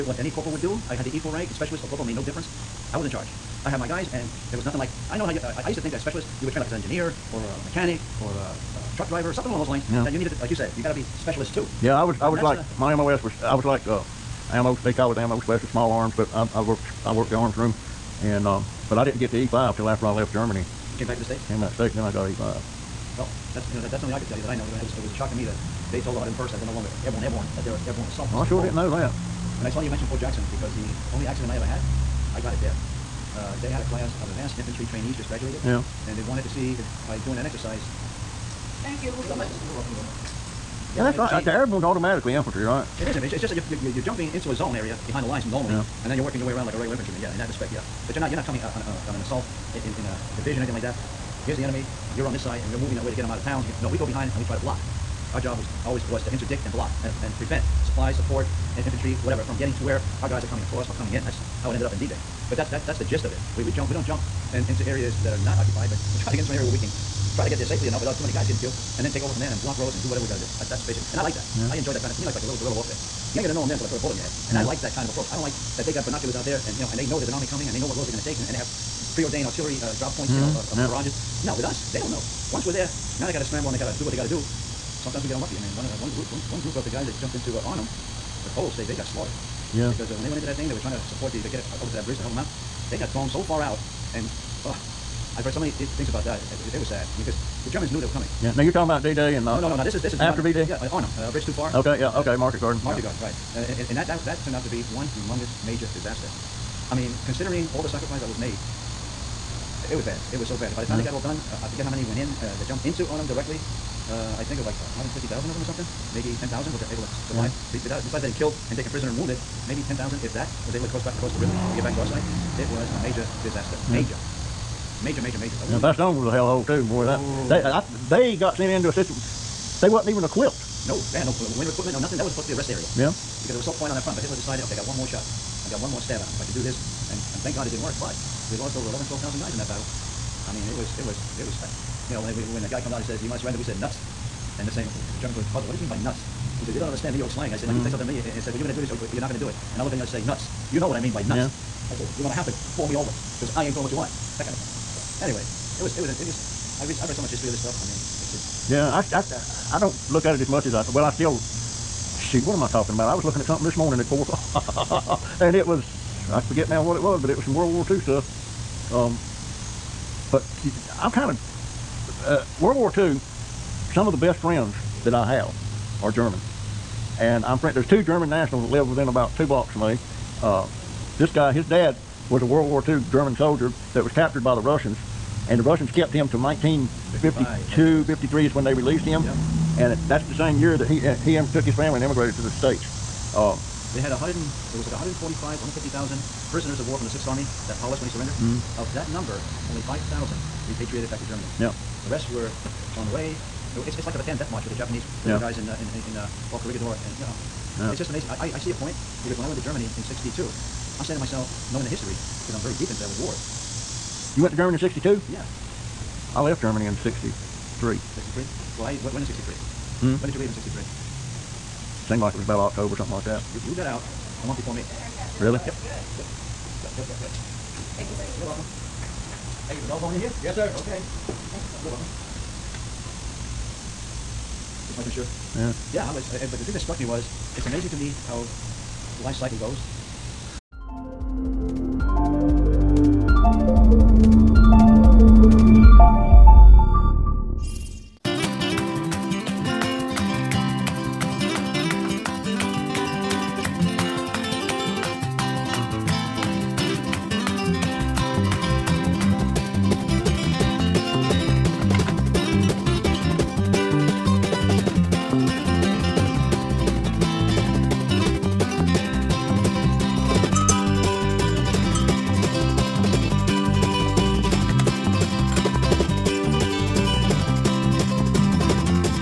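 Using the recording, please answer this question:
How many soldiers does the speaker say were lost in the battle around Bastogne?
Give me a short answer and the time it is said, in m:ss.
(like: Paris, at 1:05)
11,000 to 12,000, at 2:18.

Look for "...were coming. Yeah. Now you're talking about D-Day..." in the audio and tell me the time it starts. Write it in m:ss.
1:38.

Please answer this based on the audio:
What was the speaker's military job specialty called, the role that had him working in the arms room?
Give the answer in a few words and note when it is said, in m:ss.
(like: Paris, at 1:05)
Ammo specialist, at 0:15.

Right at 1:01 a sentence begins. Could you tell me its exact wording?
That's how it ended up in D-Day.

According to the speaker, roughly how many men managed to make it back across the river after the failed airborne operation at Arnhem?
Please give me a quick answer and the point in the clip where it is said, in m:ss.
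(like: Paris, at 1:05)
10,000, at 1:56.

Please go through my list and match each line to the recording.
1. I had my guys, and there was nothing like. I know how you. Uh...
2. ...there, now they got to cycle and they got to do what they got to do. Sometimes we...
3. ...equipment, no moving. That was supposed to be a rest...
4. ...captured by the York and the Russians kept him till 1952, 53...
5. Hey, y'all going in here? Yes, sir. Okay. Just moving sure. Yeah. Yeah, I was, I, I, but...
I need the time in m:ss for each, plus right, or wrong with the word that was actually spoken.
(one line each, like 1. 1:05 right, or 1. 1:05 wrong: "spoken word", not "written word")
1. 0:03 right
2. 1:22 wrong: "scramble", not "cycle"
3. 2:11 wrong: "nothing", not "moving"
4. 3:04 wrong: "Russians", not "York"
5. 3:49 wrong: "making", not "moving".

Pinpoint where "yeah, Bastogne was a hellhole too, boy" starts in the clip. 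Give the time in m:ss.
2:05.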